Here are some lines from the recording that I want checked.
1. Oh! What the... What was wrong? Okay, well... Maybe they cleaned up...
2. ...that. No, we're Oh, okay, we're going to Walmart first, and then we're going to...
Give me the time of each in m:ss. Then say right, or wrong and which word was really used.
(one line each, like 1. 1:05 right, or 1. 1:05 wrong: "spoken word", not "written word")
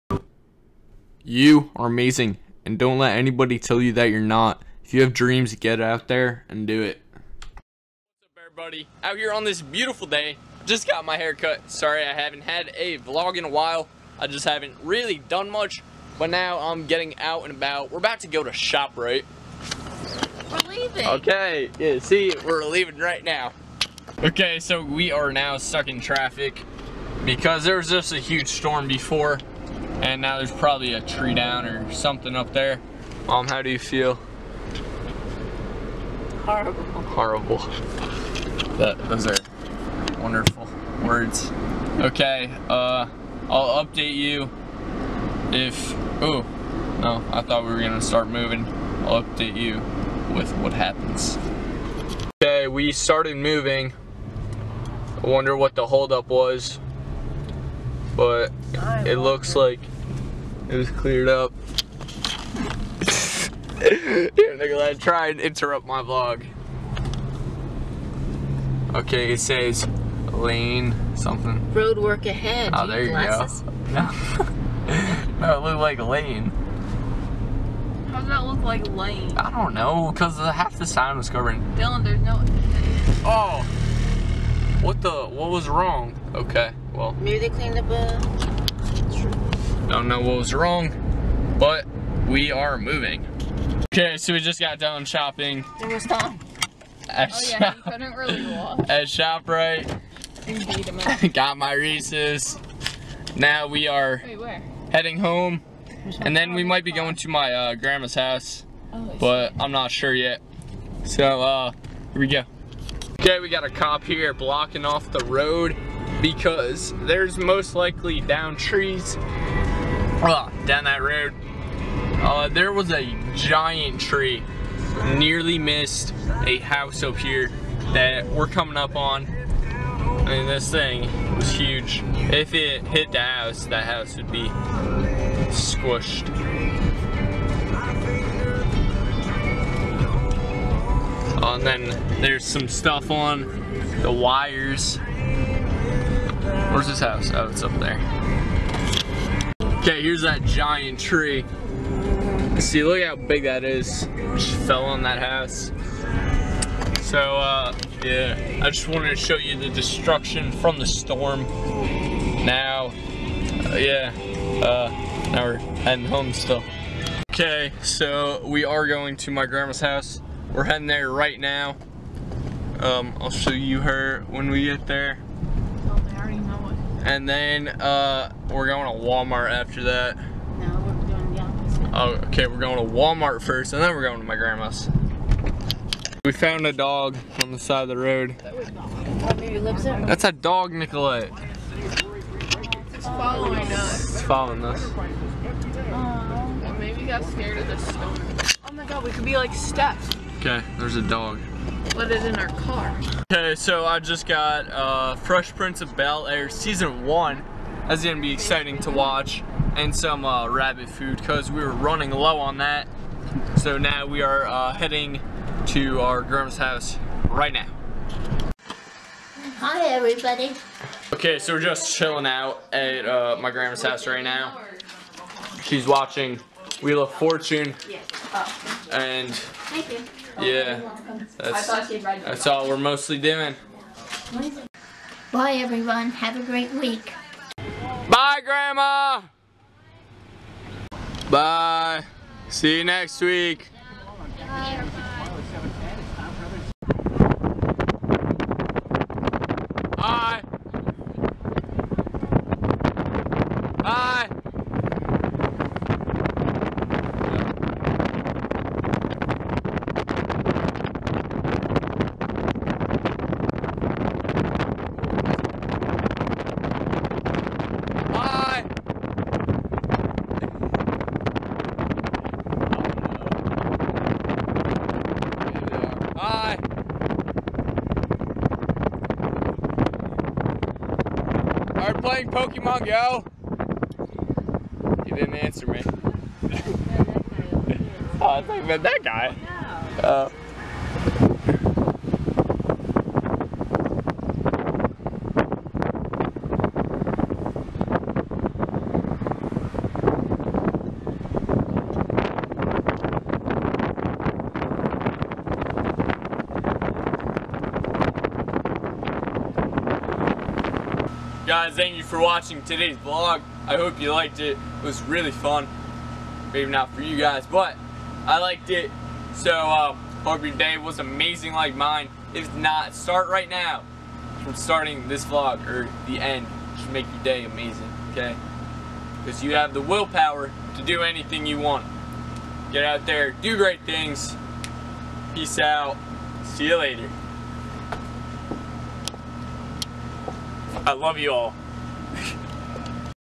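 1. 1:23 right
2. 2:59 right.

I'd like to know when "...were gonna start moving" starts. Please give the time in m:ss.
0:47.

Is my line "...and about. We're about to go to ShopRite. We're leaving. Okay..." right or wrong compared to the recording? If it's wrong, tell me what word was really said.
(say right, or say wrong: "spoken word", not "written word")
right.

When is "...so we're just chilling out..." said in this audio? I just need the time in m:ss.
3:41.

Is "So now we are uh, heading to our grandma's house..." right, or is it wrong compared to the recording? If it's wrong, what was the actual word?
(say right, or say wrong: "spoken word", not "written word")
right.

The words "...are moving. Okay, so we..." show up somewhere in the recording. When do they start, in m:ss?
1:32.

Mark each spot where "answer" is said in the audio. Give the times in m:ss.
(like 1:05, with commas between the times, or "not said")
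4:45.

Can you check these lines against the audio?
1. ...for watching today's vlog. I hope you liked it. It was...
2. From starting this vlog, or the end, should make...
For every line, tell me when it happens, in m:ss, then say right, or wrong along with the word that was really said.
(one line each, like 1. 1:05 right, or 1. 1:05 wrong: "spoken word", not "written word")
1. 5:12 right
2. 5:24 right.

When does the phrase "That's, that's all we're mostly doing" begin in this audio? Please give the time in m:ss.
3:51.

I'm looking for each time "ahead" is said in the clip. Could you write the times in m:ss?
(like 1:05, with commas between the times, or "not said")
1:12.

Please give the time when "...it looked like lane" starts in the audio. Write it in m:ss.
1:15.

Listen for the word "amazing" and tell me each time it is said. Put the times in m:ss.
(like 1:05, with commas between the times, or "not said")
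0:01, 5:20, 5:27.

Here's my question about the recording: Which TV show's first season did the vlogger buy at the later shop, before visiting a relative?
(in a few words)
Fresh Prince of Bel Air.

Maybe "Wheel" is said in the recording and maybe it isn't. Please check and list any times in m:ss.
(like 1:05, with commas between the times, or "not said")
3:46.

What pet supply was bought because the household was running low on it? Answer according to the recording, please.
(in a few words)
rabbit food.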